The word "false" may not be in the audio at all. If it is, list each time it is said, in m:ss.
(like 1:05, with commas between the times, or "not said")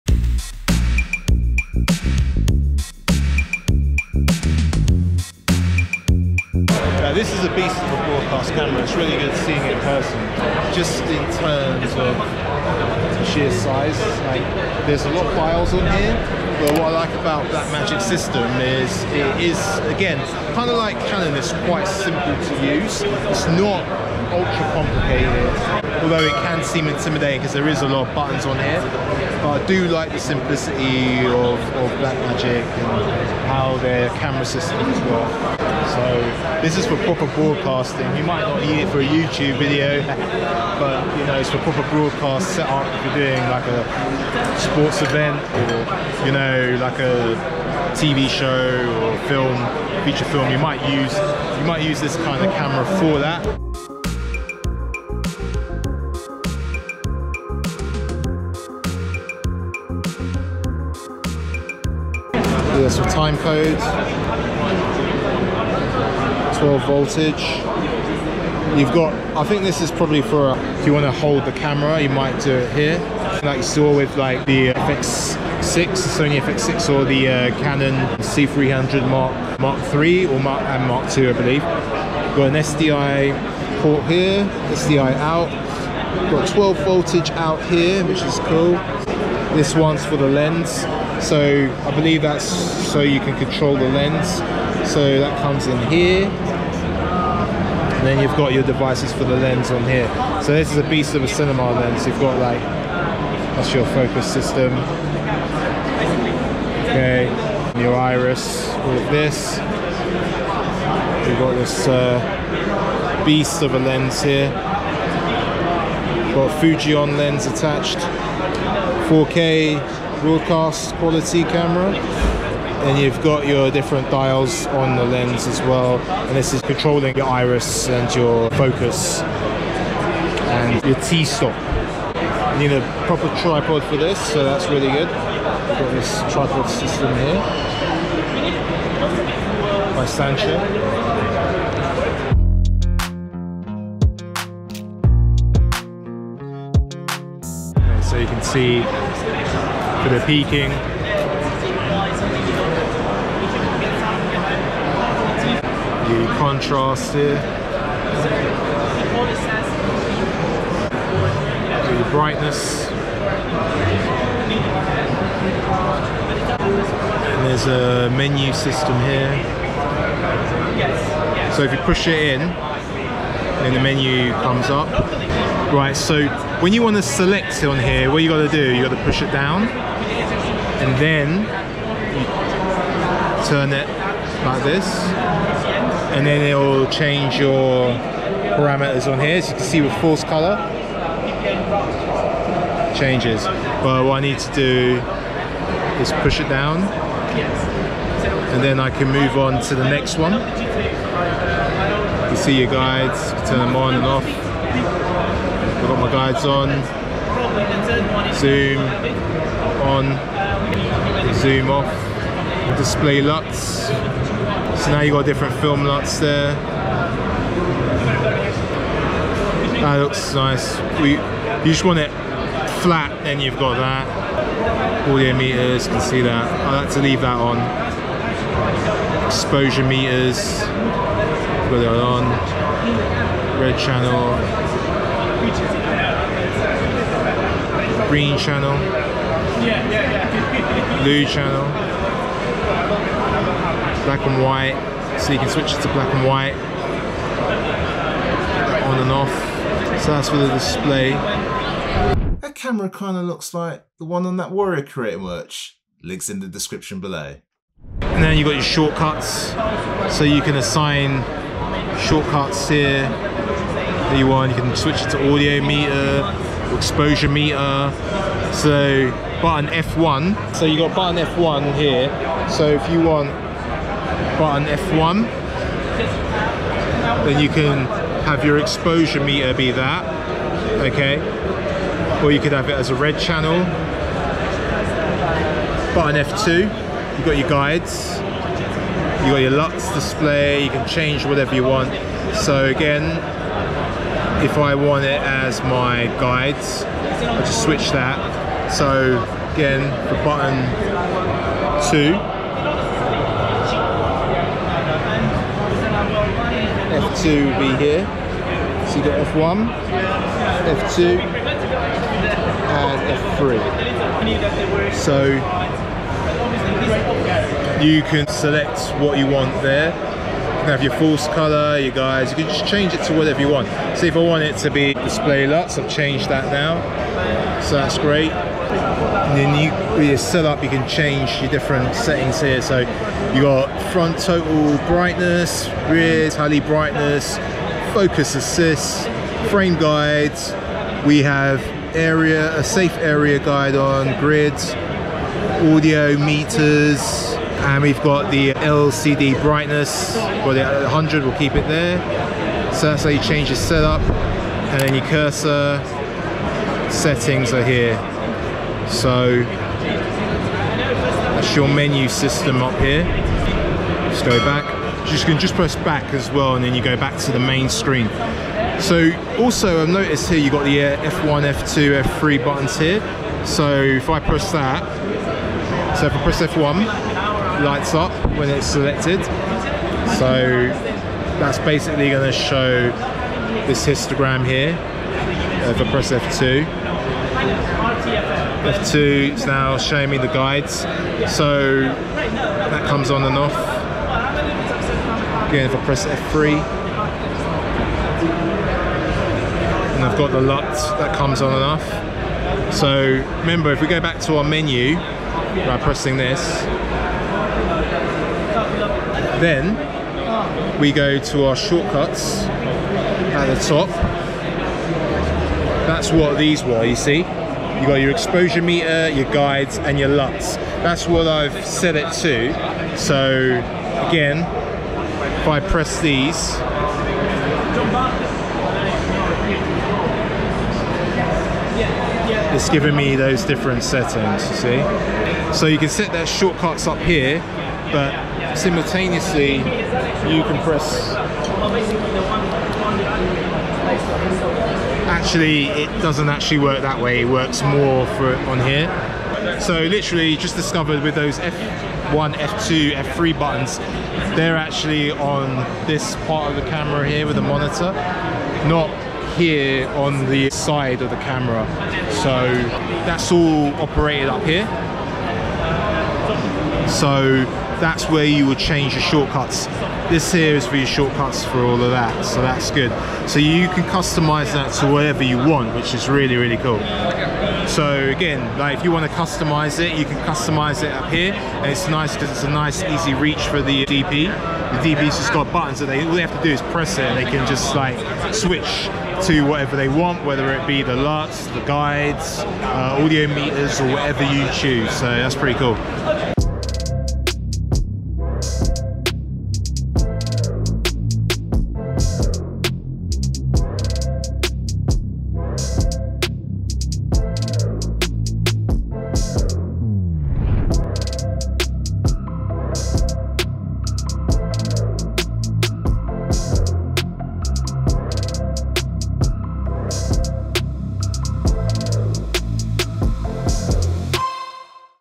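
3:10, 5:20.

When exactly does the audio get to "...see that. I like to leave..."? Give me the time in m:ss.
3:46.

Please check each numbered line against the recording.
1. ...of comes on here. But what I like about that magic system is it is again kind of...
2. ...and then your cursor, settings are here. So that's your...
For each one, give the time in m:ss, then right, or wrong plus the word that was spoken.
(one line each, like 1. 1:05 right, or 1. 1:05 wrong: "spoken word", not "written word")
1. 0:15 wrong: "files", not "comes"
2. 5:54 right.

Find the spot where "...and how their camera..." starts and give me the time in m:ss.
0:32.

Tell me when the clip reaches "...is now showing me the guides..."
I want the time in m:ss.
6:29.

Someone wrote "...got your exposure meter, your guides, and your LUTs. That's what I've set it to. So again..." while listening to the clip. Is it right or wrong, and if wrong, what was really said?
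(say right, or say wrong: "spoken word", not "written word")
right.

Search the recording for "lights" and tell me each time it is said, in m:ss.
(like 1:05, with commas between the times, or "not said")
6:17.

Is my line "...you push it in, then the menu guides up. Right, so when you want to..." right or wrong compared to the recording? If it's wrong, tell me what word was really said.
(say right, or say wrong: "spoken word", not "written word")
wrong: "comes", not "guides".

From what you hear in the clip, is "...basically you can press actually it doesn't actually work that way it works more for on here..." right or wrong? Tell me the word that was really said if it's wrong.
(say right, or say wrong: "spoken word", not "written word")
wrong: "simultaneously", not "basically".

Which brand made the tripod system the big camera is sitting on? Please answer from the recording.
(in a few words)
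Sancho.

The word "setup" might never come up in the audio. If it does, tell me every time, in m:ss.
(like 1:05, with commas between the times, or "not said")
0:42, 5:30, 5:53.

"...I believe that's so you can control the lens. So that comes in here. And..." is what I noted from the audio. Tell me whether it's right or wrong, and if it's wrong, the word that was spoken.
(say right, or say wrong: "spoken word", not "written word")
right.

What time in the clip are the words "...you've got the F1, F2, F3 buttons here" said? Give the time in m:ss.
6:10.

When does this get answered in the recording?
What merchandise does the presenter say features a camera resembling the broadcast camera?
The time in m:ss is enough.
4:14.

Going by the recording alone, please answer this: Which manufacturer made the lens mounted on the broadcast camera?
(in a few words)
Fujinon.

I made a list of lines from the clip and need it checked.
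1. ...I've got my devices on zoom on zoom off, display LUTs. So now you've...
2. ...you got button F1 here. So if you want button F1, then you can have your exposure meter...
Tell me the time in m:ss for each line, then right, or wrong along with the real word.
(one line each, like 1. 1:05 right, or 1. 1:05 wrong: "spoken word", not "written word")
1. 3:25 wrong: "guides", not "devices"
2. 4:30 right.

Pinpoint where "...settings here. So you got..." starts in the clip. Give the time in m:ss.
5:31.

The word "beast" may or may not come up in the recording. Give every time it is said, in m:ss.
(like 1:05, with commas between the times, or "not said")
0:07, 1:40, 1:53.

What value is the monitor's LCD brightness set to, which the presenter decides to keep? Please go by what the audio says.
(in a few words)
100.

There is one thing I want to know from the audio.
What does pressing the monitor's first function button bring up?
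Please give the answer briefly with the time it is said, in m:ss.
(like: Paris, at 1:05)
Histogram, at 6:23.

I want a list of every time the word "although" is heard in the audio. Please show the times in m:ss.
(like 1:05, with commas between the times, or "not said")
0:26.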